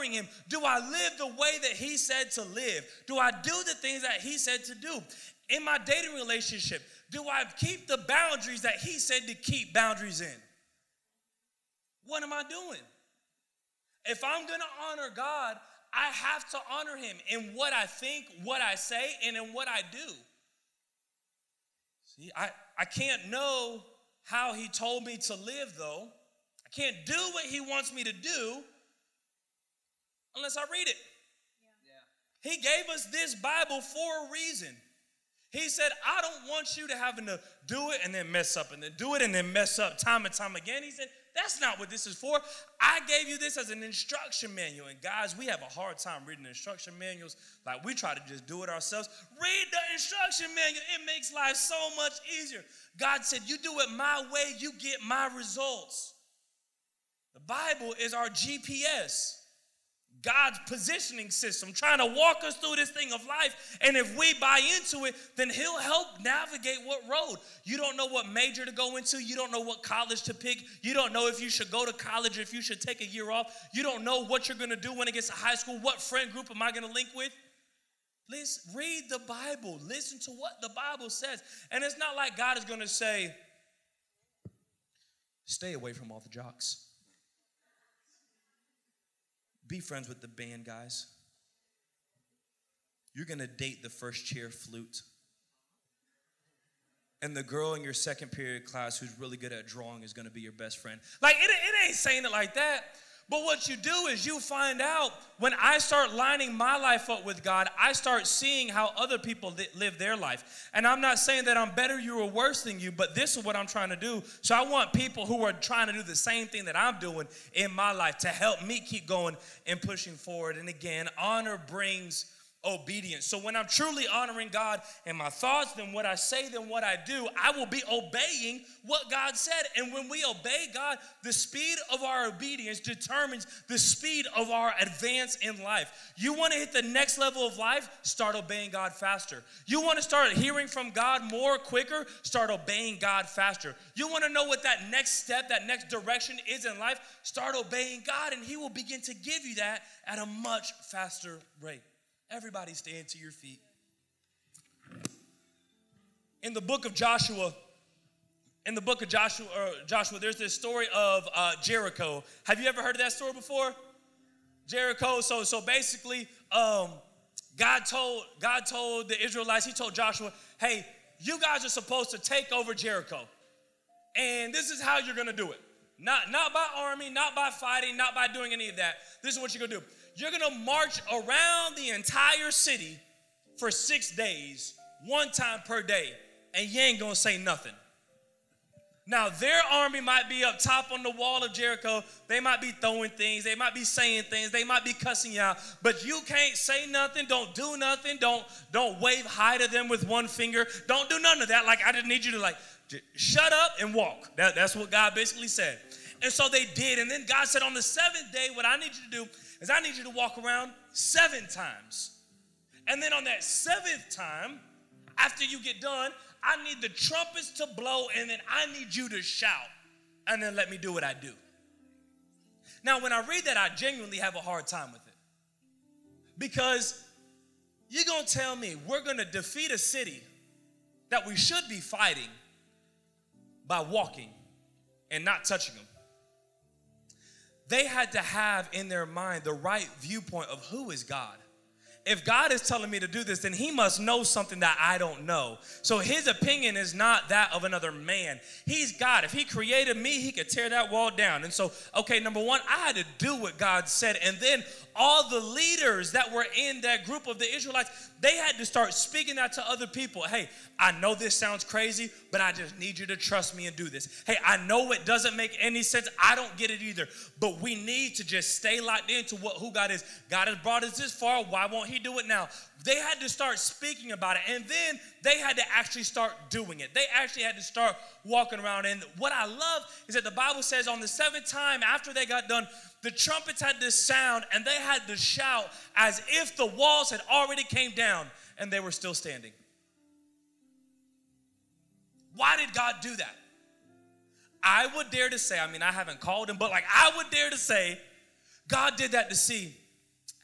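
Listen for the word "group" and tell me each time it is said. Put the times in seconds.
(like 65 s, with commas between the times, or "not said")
76 s, 257 s.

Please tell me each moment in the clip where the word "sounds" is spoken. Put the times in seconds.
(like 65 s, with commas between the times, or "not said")
261 s, 283 s.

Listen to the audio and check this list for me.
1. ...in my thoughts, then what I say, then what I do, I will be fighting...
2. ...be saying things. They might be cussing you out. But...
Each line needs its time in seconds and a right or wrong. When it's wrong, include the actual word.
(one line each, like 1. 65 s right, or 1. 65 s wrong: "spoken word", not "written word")
1. 125 s wrong: "obeying", not "fighting"
2. 193 s right.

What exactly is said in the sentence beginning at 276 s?
They actually had to start walking around.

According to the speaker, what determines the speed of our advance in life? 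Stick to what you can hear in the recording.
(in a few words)
the speed of our obedience.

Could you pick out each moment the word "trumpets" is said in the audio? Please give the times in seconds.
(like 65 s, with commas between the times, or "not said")
216 s, 283 s.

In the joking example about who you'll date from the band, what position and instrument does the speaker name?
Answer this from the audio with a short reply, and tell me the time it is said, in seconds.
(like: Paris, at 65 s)
first chair flute, at 93 s.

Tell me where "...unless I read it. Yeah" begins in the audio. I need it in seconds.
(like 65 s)
30 s.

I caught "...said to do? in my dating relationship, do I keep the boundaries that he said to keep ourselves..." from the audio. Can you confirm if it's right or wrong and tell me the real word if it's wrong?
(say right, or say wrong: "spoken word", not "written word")
wrong: "boundaries", not "ourselves".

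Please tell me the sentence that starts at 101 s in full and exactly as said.
Like, it, it ain't saying it like that.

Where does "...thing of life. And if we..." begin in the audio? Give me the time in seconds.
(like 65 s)
62 s.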